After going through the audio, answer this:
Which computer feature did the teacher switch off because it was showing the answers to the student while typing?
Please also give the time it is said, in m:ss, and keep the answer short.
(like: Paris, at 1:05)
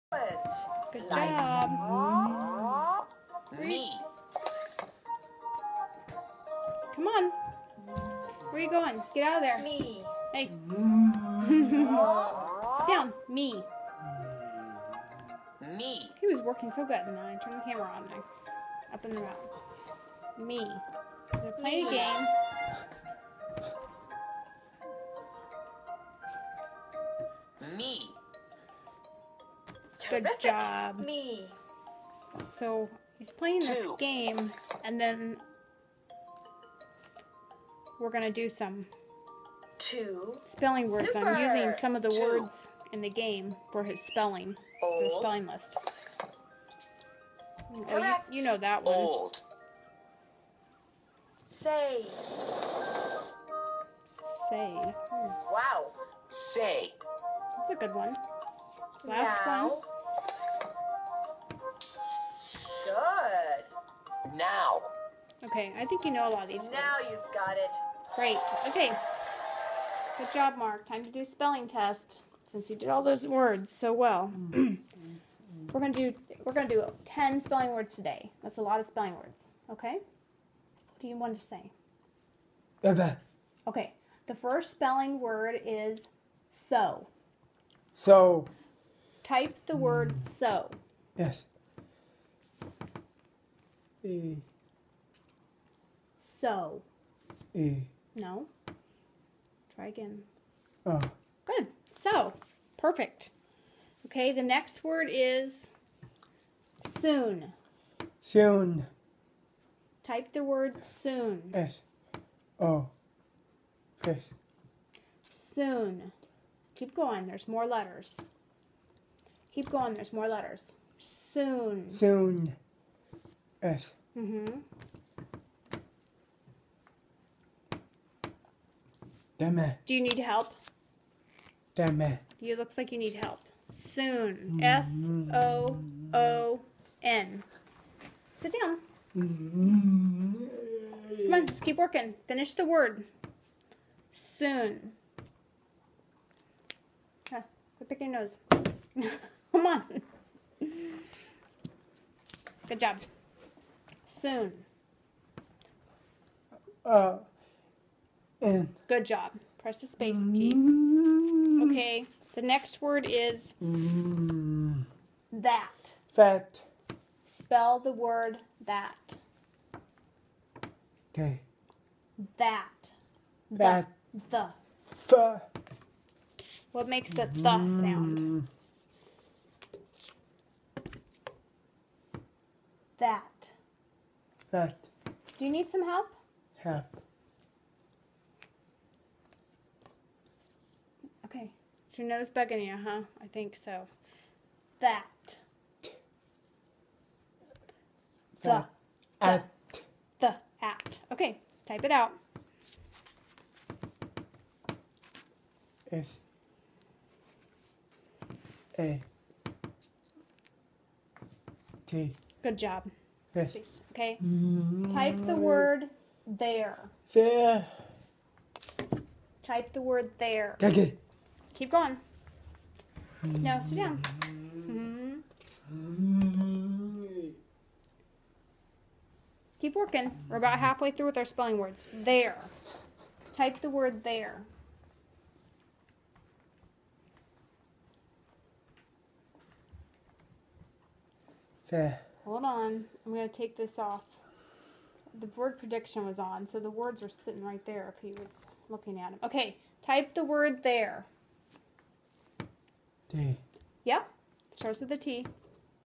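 word prediction, at 4:05.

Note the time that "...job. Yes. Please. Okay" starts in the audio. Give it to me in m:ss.
3:32.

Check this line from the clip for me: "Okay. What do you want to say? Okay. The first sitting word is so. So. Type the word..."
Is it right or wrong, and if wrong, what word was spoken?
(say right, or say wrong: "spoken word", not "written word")
wrong: "spelling", not "sitting".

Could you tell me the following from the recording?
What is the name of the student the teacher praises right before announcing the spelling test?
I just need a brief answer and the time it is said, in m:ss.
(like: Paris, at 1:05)
Mark, at 1:10.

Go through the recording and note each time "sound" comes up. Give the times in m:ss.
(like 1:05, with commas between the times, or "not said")
2:57.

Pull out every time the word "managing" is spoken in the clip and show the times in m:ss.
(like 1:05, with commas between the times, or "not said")
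not said.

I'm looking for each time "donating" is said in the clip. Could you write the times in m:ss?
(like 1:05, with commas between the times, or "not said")
not said.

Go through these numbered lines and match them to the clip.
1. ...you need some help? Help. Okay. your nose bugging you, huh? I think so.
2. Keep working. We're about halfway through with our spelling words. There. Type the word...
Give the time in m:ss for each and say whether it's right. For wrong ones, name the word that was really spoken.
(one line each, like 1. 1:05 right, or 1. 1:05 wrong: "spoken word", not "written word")
1. 3:05 right
2. 3:49 right.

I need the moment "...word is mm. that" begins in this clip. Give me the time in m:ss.
2:42.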